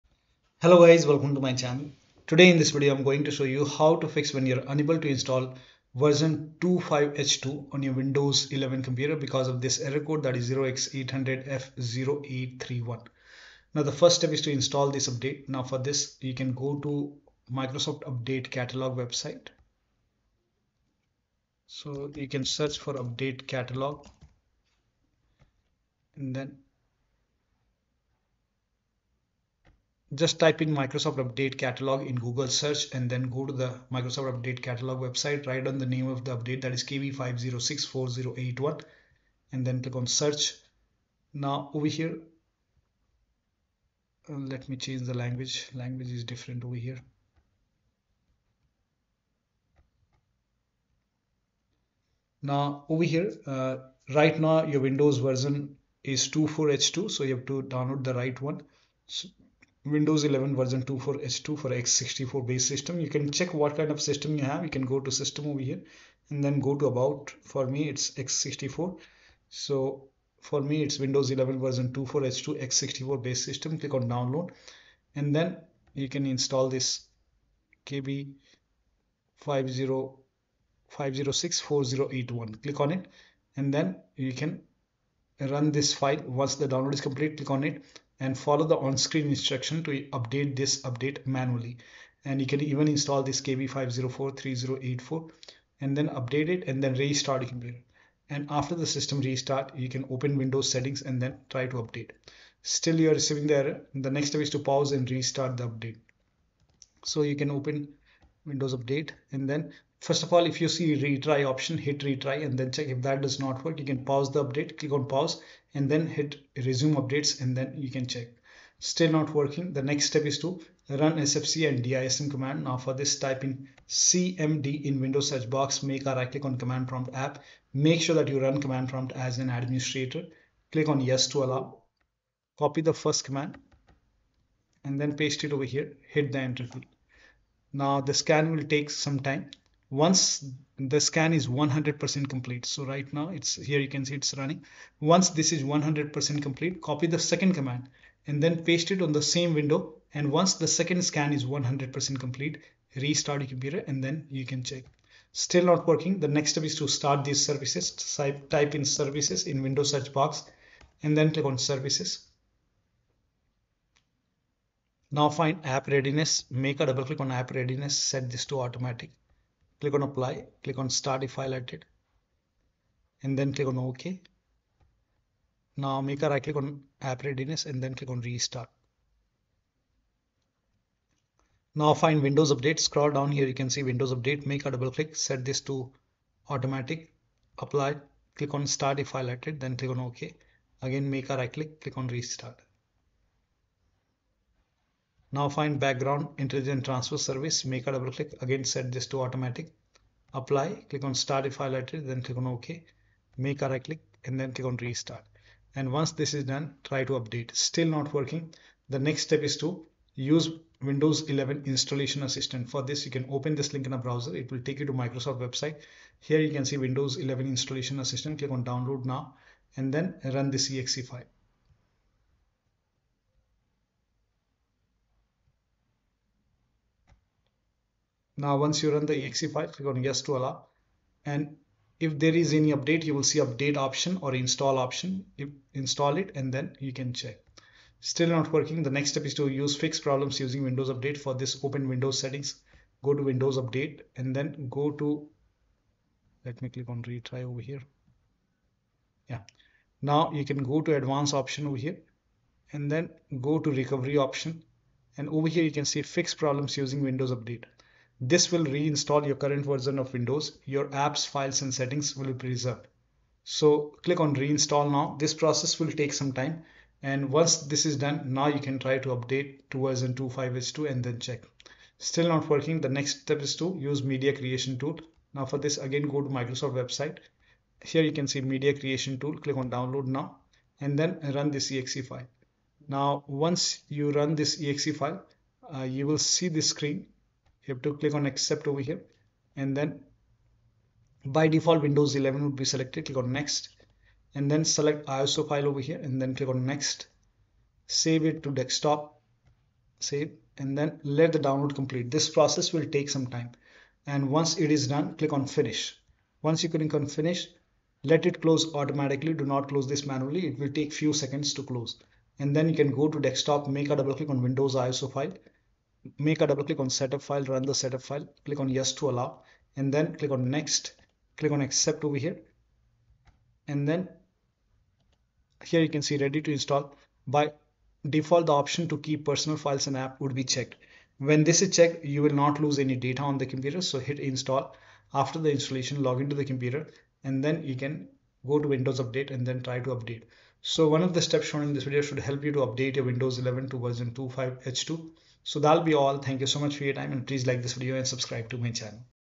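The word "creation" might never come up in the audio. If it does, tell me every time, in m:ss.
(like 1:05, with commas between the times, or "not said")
4:34, 4:38.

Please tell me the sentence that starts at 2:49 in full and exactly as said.
Click on apply, click on start if highlighted, and then click on OK.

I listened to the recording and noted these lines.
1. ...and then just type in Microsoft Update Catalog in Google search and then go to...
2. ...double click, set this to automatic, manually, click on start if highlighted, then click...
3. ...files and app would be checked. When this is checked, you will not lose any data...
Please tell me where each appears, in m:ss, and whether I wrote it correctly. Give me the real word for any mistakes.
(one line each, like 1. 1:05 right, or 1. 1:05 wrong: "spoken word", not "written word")
1. 0:26 right
2. 3:04 wrong: "apply", not "manually"
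3. 5:29 right.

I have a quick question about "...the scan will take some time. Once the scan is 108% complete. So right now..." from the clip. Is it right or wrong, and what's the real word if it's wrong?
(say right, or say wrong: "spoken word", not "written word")
wrong: "100", not "108".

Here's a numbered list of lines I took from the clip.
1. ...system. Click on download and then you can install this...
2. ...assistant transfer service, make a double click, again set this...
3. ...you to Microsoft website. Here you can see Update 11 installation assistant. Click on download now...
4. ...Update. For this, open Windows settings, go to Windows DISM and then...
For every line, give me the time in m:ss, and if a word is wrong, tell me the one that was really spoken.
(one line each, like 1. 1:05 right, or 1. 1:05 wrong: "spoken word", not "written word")
1. 1:13 right
2. 3:16 wrong: "intelligent", not "assistant"
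3. 3:34 wrong: "Windows", not "Update"
4. 4:00 wrong: "Update", not "DISM".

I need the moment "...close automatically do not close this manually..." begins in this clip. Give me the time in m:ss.
5:08.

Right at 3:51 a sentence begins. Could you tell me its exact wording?
And if there is any update, you will see update option or install option.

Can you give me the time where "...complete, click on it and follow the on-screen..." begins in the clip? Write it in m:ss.
1:27.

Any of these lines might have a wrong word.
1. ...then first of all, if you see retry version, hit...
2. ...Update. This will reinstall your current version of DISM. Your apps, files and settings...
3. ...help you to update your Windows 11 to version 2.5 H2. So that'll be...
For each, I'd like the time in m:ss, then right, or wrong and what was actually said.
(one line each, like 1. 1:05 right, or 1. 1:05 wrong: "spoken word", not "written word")
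1. 1:49 wrong: "option", not "version"
2. 4:17 wrong: "Windows", not "DISM"
3. 5:42 right.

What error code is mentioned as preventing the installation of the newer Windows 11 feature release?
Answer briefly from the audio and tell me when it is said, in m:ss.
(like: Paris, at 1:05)
0x800F0831, at 0:10.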